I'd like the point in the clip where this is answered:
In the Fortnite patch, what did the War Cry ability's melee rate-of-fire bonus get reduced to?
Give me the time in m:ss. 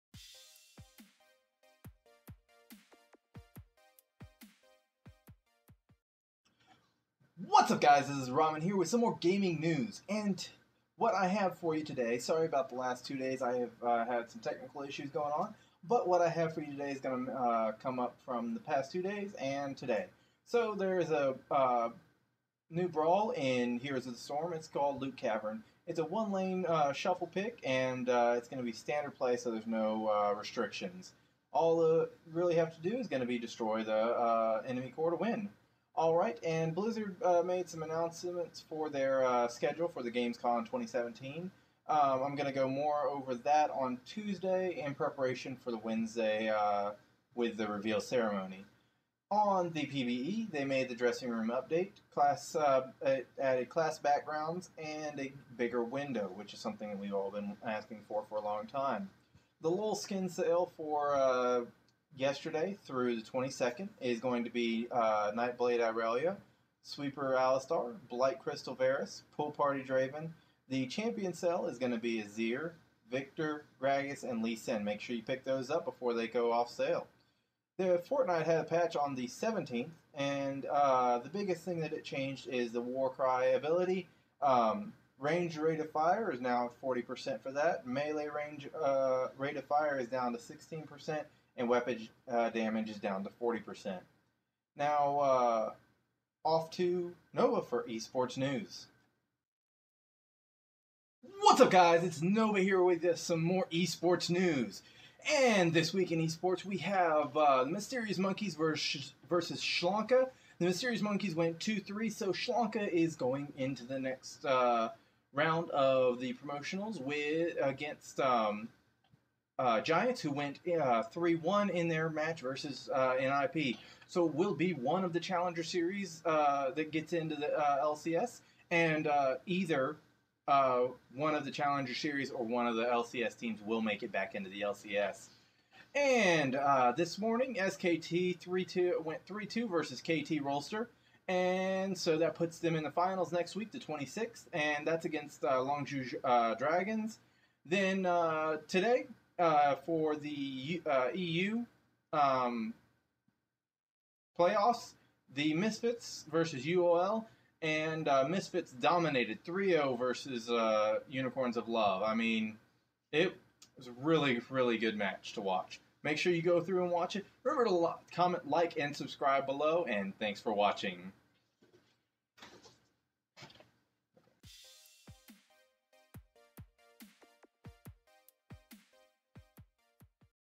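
1:30.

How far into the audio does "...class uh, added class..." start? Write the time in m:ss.
0:52.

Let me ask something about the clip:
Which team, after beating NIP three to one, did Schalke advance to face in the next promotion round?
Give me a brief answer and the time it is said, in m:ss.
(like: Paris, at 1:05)
Giants, at 1:59.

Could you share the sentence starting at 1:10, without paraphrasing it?
The champion cell is going to be Azir, Viktor, Gragas, and Lee Sin.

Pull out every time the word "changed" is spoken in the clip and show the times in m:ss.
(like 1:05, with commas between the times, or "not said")
1:22.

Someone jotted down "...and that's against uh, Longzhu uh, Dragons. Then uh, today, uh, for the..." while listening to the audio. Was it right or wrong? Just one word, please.
right.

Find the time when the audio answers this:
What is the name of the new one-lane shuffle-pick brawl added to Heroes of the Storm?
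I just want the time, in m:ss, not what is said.
0:25.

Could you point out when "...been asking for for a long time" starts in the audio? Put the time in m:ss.
0:57.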